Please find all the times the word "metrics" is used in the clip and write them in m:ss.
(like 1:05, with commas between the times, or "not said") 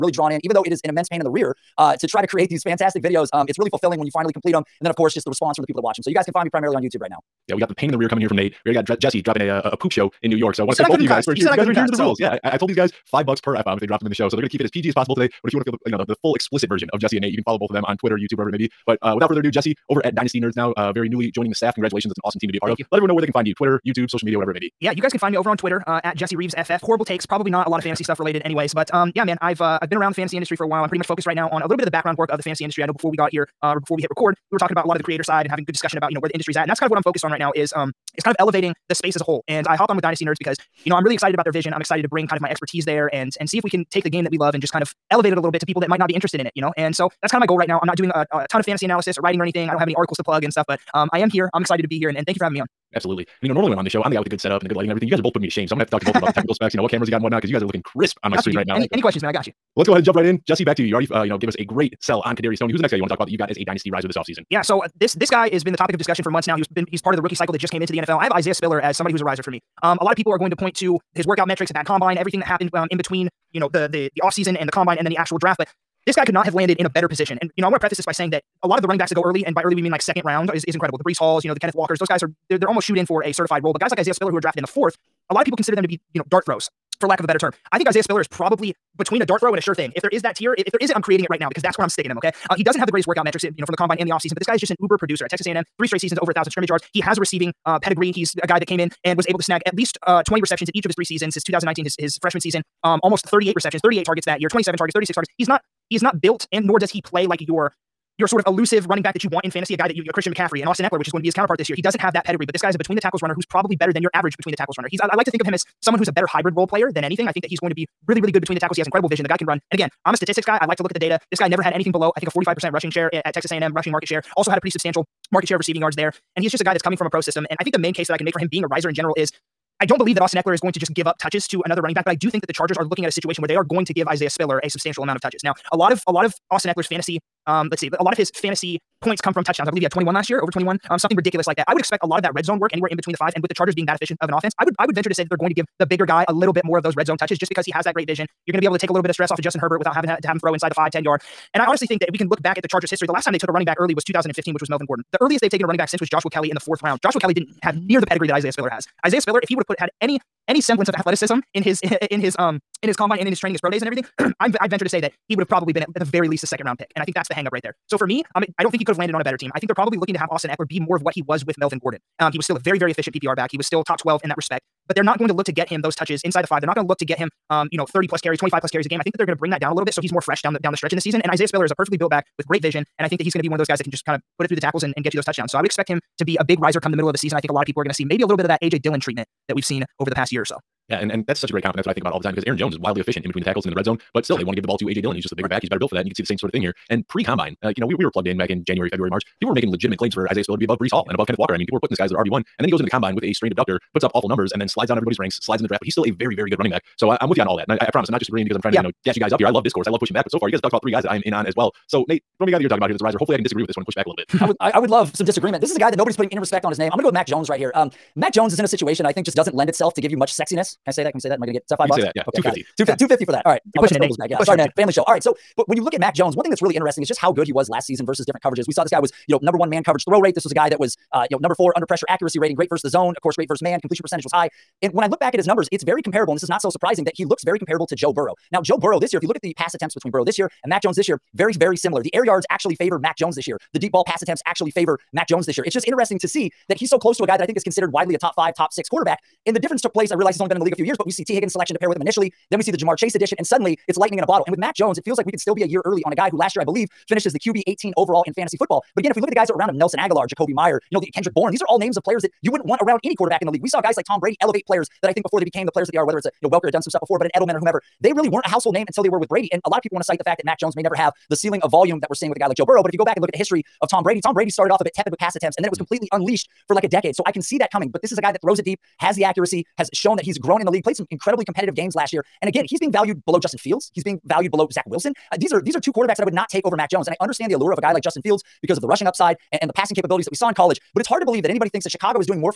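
1:11, 1:33.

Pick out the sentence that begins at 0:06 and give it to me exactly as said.
So you guys can find me primarily on YouTube right now.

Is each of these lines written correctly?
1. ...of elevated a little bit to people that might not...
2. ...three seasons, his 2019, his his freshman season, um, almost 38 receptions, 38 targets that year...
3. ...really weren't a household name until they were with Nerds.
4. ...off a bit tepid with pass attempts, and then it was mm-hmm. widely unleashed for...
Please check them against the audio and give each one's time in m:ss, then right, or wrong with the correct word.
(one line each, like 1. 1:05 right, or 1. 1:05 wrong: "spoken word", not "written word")
1. 0:44 right
2. 1:40 right
3. 4:28 wrong: "Brady", not "Nerds"
4. 4:34 wrong: "completely", not "widely".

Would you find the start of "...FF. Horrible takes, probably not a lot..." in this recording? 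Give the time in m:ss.
0:26.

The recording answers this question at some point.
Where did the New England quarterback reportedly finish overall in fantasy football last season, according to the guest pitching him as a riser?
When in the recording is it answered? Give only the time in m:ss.
4:17.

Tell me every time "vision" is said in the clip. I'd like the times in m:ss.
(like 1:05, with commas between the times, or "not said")
0:41, 1:59, 2:28, 3:02.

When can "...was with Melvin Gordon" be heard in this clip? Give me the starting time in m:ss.
2:51.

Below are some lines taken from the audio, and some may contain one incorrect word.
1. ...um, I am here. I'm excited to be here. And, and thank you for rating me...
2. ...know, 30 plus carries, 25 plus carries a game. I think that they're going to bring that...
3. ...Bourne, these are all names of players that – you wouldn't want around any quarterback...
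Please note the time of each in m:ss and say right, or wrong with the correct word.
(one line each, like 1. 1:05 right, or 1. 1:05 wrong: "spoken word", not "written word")
1. 0:50 wrong: "having", not "rating"
2. 2:57 right
3. 4:21 right.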